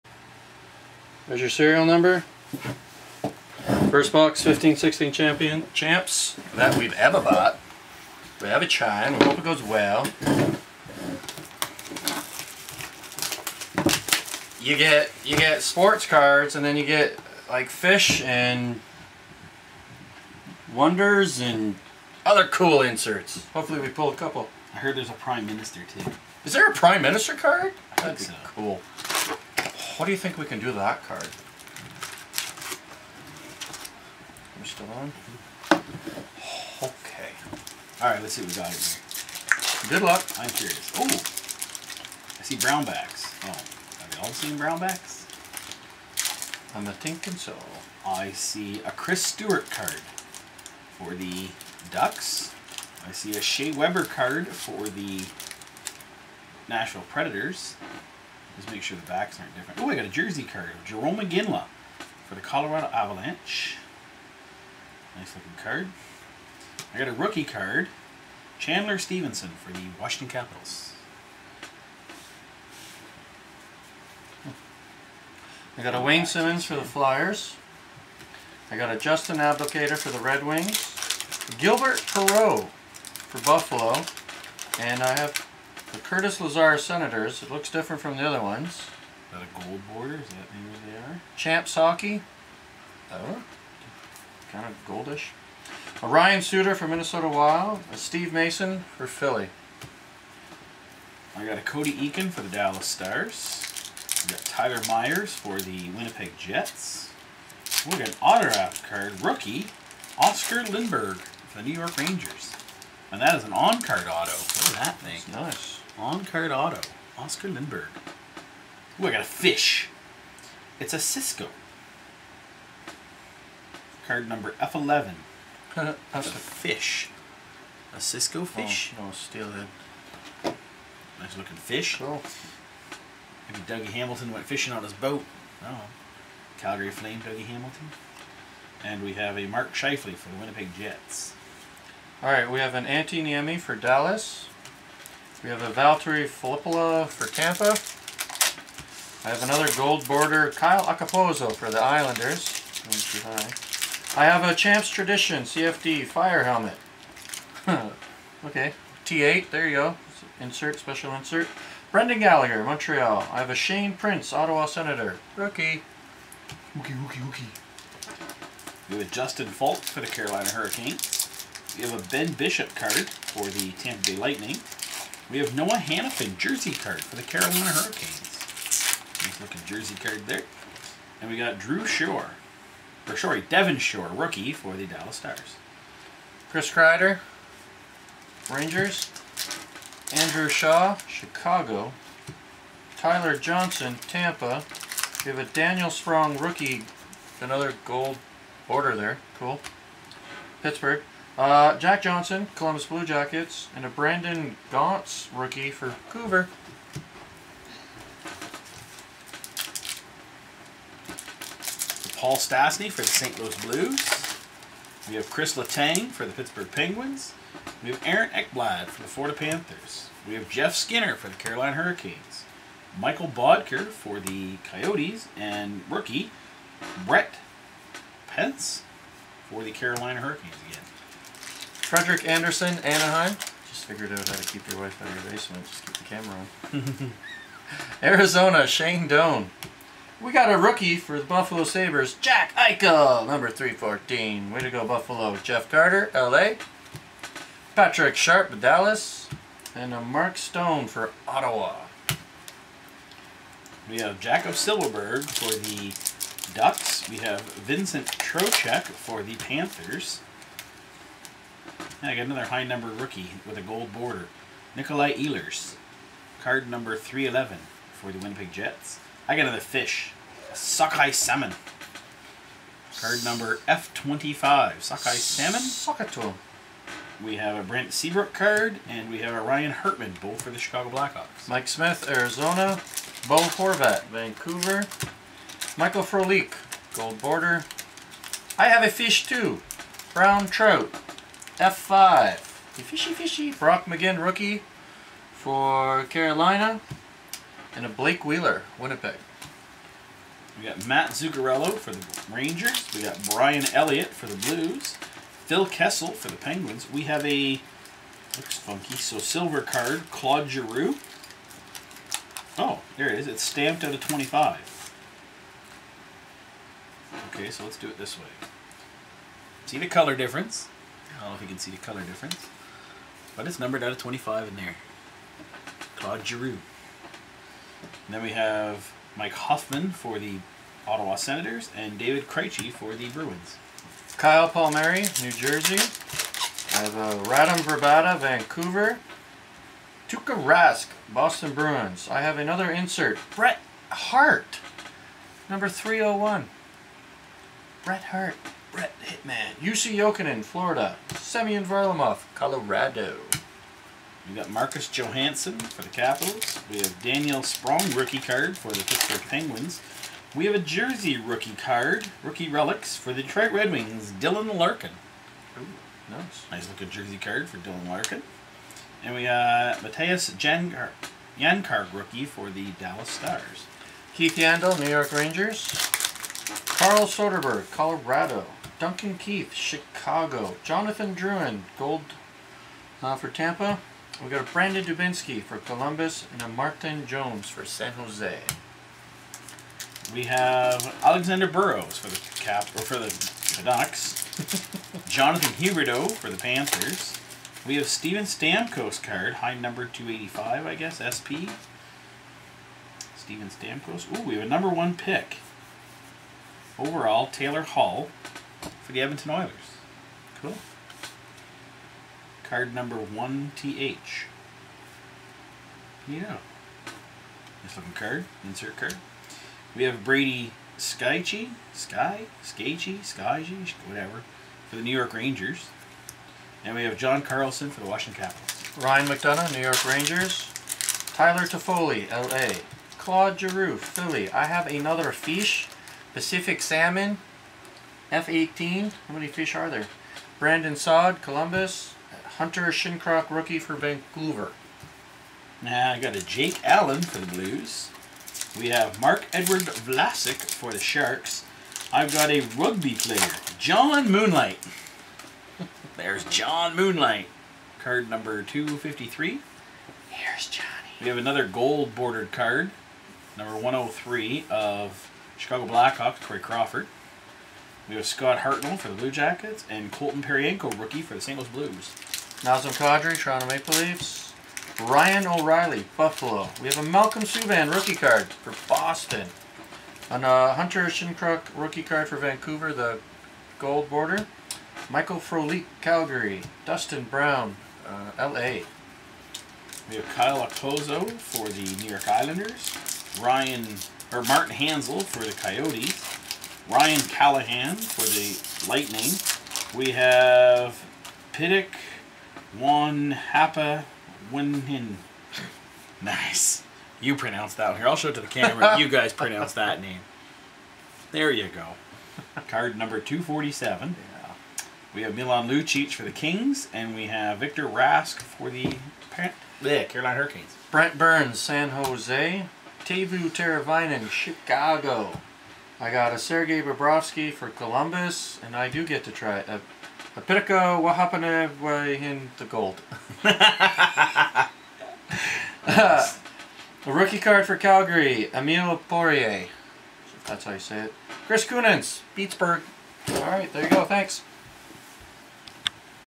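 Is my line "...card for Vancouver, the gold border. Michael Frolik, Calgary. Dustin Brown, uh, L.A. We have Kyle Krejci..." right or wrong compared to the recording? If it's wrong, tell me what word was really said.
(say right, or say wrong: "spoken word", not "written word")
wrong: "Okposo", not "Krejci".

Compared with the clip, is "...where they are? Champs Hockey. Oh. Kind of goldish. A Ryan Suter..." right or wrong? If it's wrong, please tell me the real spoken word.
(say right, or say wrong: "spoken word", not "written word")
right.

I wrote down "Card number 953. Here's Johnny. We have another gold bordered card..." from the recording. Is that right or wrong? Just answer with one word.
wrong.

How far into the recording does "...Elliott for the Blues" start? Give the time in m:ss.
5:03.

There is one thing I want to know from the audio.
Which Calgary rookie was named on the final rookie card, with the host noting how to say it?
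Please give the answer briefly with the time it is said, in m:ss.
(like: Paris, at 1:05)
Emile Poirier, at 8:58.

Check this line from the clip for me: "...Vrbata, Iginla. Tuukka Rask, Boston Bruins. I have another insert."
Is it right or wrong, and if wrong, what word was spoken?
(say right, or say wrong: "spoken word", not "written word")
wrong: "Vancouver", not "Iginla".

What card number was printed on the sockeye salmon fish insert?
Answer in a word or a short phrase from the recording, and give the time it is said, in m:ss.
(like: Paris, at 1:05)
F25, at 4:33.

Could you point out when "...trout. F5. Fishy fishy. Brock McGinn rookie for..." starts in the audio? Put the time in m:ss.
4:50.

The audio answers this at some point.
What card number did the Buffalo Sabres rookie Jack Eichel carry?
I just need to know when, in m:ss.
4:03.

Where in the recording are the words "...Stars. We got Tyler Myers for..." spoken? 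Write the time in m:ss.
1:42.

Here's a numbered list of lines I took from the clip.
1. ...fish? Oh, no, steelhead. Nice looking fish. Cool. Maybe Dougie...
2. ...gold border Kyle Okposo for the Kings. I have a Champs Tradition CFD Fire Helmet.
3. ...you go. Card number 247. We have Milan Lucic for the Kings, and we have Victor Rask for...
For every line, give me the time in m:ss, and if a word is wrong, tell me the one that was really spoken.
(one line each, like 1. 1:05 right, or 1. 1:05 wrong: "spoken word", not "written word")
1. 2:08 right
2. 2:29 wrong: "Islanders", not "Kings"
3. 8:31 right.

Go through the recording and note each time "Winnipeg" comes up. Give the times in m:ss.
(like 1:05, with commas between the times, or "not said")
1:45, 2:20, 4:28, 4:58.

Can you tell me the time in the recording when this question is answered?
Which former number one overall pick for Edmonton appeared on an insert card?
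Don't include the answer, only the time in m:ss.
6:47.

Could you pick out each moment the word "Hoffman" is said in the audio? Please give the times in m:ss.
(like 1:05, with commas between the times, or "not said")
5:29.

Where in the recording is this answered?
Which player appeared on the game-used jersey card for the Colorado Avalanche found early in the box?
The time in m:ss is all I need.
1:00.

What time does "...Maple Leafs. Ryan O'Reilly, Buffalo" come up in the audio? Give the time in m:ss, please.
7:53.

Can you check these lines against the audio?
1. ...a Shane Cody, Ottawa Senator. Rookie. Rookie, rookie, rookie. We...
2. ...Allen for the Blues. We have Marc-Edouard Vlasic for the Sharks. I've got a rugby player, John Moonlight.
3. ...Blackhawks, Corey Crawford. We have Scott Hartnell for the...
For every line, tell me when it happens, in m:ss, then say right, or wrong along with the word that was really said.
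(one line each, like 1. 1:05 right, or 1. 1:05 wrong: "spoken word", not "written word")
1. 2:43 wrong: "Prince", not "Cody"
2. 7:26 right
3. 7:45 right.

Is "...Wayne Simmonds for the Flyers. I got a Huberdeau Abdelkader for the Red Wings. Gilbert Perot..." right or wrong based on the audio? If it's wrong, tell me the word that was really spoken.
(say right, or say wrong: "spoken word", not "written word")
wrong: "Justin", not "Huberdeau".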